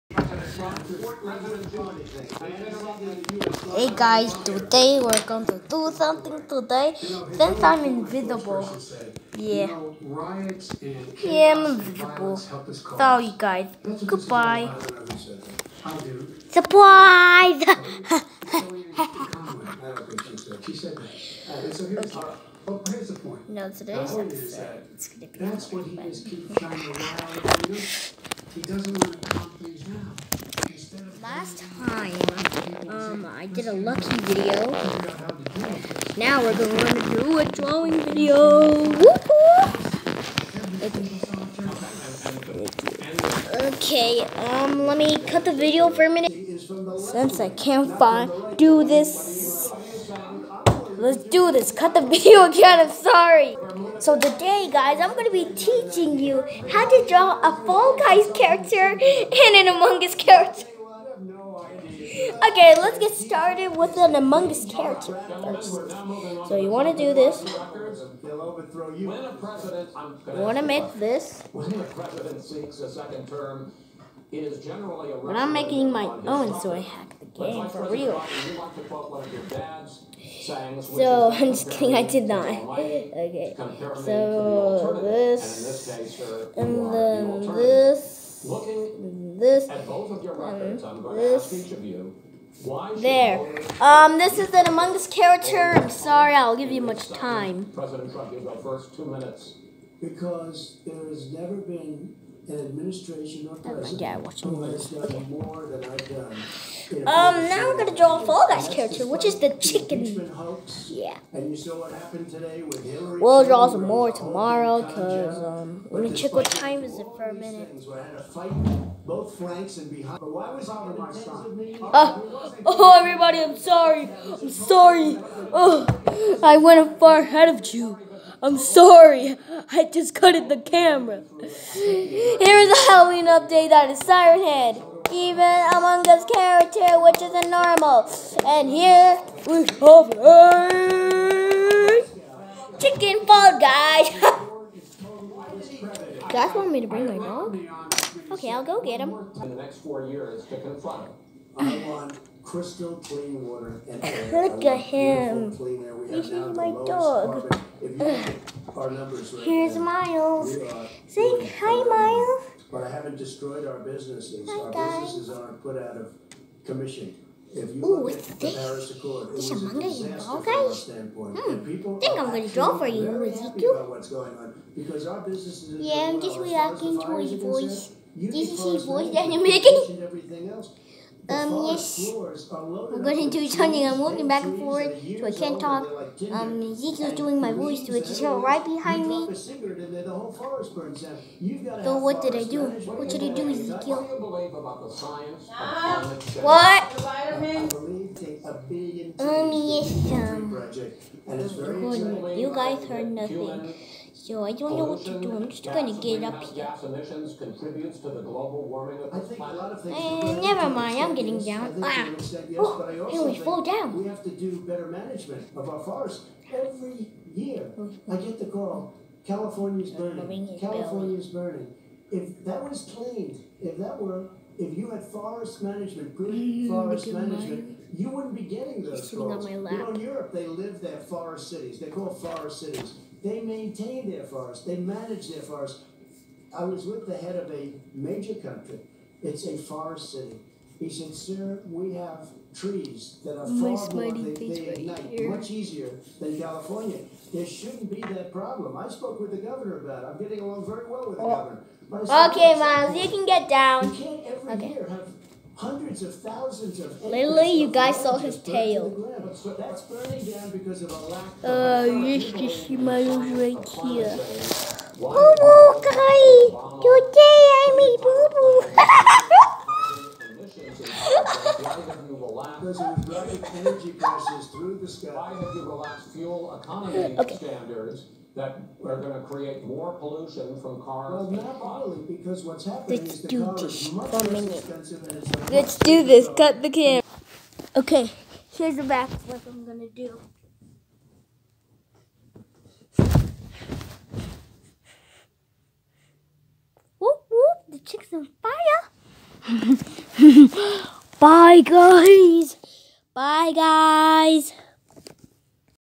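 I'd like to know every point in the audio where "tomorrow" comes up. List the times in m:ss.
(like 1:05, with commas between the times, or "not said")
1:54.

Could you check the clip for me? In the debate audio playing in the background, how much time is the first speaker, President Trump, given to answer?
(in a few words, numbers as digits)
2 minutes.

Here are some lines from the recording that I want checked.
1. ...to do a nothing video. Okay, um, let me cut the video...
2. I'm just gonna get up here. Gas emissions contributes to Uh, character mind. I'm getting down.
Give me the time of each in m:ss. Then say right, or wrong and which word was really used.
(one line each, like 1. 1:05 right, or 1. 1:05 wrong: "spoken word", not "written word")
1. 0:36 wrong: "drawing", not "nothing"
2. 3:25 wrong: "never", not "character".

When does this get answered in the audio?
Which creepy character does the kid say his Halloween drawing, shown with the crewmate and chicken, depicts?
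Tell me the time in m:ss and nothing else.
2:13.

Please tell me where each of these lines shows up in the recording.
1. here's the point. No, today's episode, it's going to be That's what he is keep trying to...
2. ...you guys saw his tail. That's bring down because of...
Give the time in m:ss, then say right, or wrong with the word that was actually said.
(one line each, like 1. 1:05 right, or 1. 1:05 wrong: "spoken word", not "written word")
1. 0:21 right
2. 4:17 wrong: "burning", not "bring".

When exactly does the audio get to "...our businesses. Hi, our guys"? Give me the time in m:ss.
2:43.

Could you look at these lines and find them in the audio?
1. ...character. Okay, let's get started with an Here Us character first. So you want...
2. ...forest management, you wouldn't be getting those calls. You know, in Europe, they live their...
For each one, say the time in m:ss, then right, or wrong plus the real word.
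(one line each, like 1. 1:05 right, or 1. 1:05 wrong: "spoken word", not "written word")
1. 1:00 wrong: "Among", not "Here"
2. 3:46 right.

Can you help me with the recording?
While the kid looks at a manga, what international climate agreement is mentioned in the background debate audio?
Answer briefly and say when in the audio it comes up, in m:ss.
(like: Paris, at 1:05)
Paris Accord, at 2:48.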